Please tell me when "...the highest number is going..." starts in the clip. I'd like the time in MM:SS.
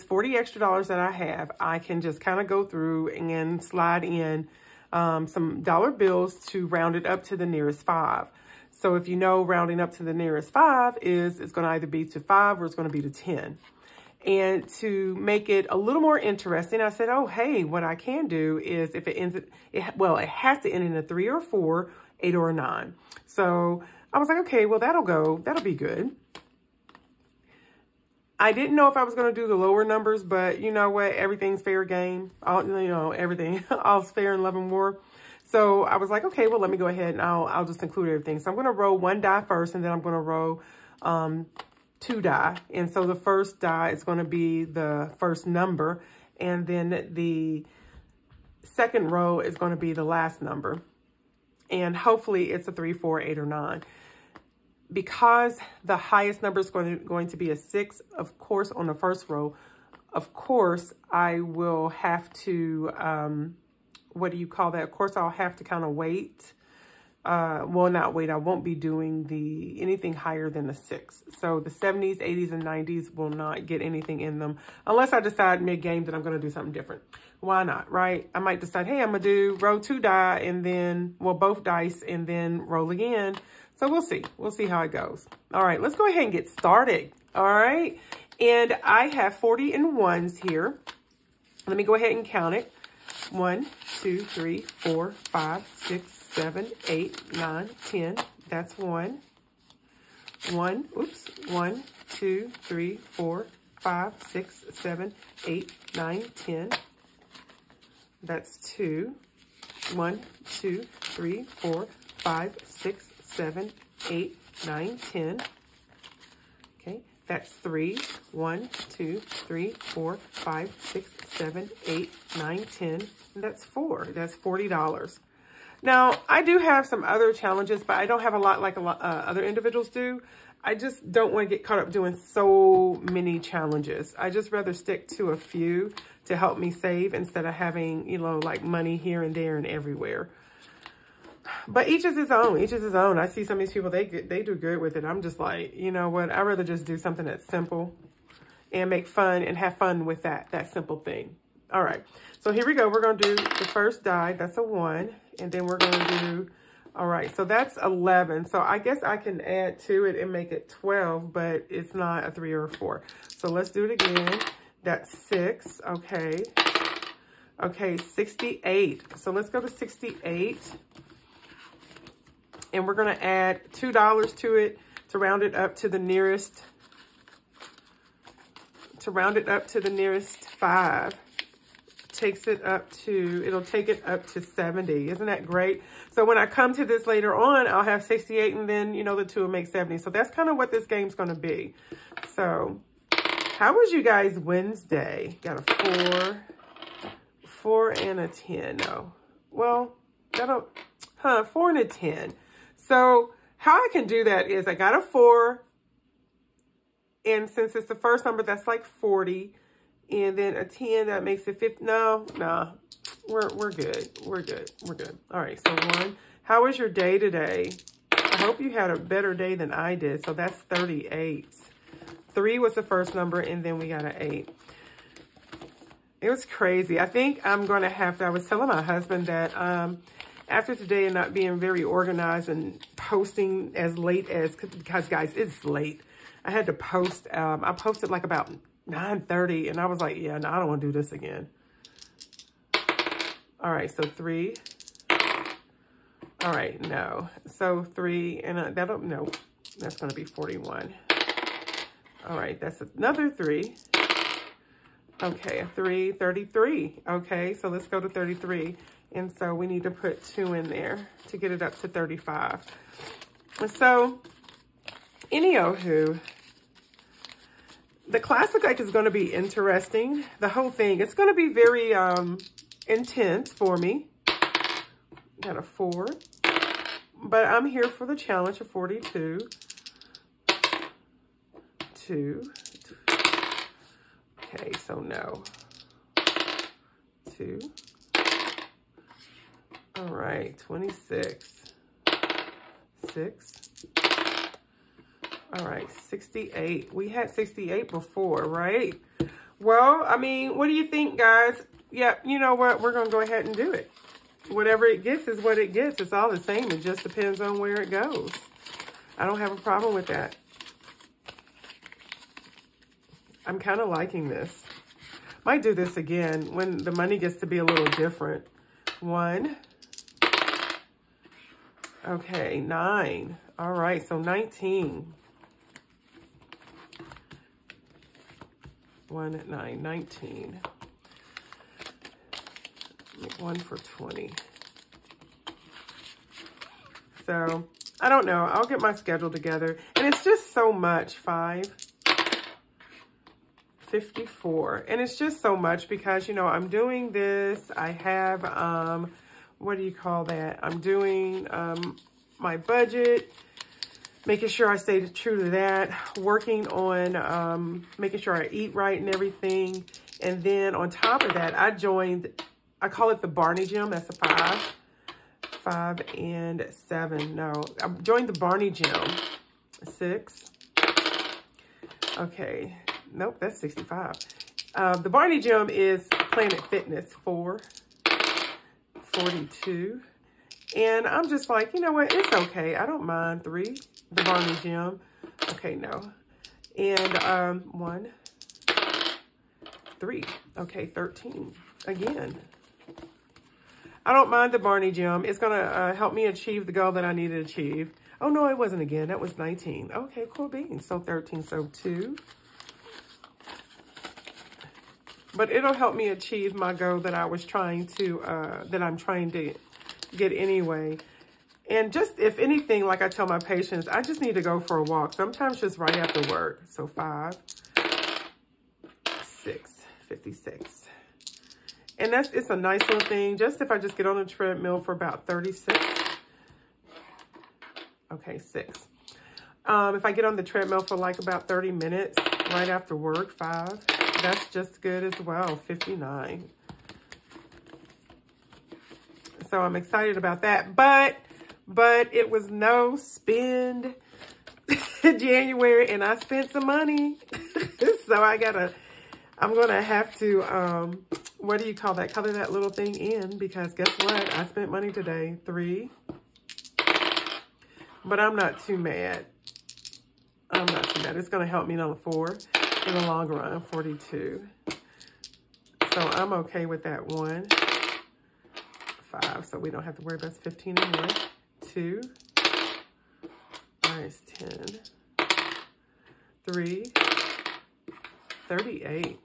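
00:55.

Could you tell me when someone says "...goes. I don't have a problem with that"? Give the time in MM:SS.
05:07.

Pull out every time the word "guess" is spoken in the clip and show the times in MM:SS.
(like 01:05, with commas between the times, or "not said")
02:38, 07:33.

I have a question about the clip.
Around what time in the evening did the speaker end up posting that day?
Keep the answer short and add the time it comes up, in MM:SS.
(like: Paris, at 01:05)
9:30, at 03:58.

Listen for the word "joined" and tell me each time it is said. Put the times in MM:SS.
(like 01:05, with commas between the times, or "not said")
06:01, 06:07.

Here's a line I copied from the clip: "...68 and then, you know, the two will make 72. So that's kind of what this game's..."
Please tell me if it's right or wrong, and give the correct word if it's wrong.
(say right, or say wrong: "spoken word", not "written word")
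wrong: "70", not "72".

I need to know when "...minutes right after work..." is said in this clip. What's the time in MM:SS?
07:11.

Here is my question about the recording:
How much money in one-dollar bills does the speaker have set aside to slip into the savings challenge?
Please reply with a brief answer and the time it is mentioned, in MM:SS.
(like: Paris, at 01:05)
$40, at 02:04.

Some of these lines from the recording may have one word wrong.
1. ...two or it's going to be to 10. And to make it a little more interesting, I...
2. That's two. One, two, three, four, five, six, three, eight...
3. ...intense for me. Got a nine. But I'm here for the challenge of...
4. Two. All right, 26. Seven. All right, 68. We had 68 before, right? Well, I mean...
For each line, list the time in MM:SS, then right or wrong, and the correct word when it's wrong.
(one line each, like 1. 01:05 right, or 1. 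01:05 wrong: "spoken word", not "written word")
1. 00:12 wrong: "five", not "two"
2. 01:48 wrong: "seven", not "three"
3. 04:32 wrong: "four", not "nine"
4. 04:47 wrong: "Six", not "Seven".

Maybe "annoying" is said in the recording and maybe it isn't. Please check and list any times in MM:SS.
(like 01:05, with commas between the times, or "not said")
not said.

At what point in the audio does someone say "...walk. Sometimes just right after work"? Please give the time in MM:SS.
06:54.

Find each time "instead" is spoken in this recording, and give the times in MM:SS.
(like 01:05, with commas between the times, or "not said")
02:17.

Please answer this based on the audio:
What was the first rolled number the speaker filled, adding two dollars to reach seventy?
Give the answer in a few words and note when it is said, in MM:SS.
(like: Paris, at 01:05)
68, at 02:47.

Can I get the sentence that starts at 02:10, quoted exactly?
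I just don't want to get caught up doing so many challenges.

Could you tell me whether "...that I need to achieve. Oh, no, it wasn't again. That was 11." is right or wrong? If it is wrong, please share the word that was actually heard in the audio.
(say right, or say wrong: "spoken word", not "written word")
wrong: "19", not "11".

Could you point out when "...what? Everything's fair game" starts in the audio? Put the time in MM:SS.
00:30.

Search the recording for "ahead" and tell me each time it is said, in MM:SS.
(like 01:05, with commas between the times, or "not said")
00:36, 01:26, 01:31, 05:03.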